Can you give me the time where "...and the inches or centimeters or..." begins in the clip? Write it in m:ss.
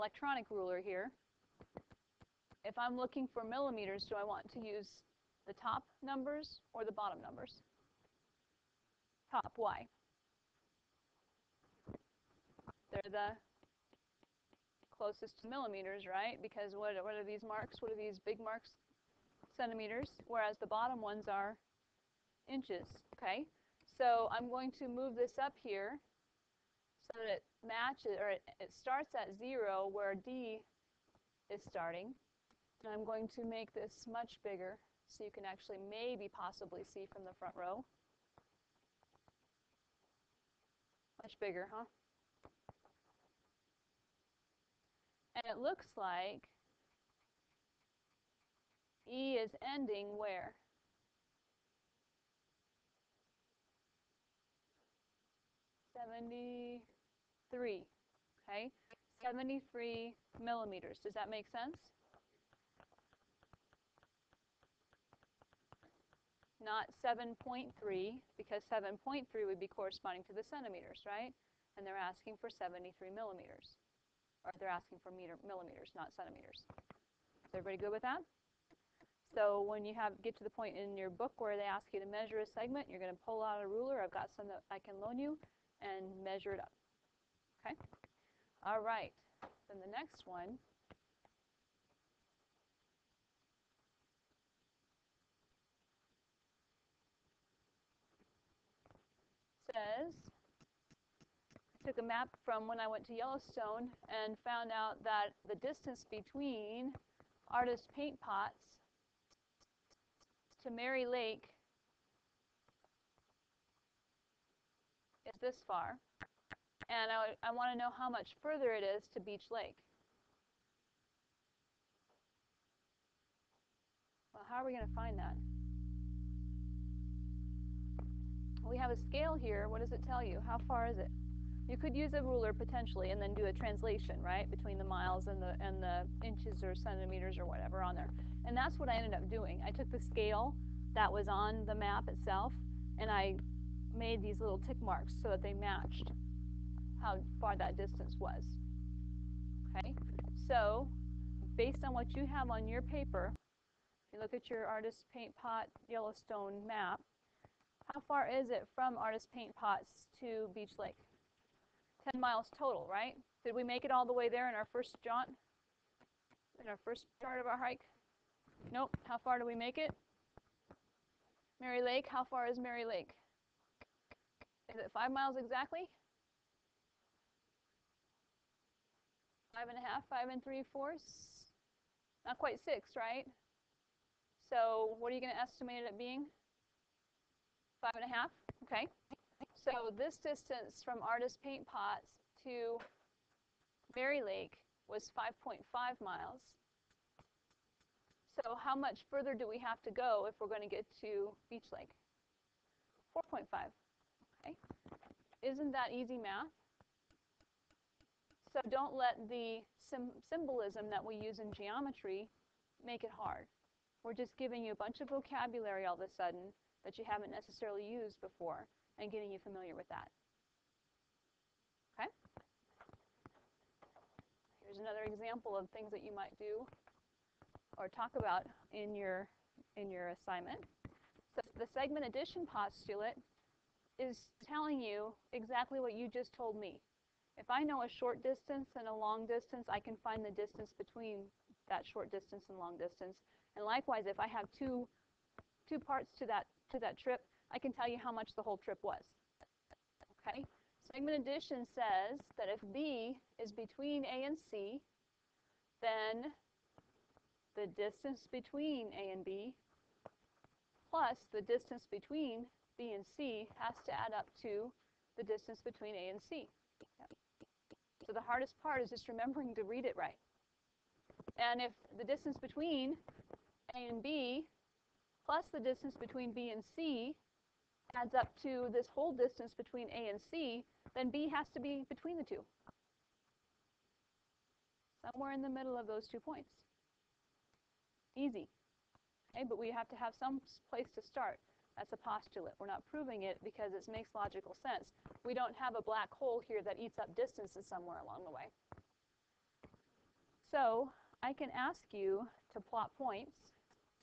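2:15.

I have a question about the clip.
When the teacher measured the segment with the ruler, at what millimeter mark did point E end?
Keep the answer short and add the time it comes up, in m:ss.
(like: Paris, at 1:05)
73, at 0:59.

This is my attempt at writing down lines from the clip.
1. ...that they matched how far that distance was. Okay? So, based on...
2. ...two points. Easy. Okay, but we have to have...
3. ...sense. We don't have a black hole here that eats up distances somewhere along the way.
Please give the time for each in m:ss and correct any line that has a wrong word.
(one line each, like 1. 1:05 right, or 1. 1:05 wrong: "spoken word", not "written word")
1. 2:25 right
2. 4:46 right
3. 4:54 right.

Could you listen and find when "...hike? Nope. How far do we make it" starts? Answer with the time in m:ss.
2:47.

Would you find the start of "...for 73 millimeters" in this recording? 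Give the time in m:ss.
1:12.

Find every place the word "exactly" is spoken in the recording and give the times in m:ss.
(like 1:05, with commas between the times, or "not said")
2:55, 3:55.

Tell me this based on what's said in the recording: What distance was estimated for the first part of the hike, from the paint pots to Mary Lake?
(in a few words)
5.5 miles.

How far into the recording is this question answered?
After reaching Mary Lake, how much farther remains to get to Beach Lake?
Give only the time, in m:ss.
3:23.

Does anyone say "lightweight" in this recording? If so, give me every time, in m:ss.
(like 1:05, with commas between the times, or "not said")
not said.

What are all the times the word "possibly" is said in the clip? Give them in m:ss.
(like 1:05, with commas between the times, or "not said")
0:36.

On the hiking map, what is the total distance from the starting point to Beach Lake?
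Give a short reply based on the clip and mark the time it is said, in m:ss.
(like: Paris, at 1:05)
10 miles, at 2:42.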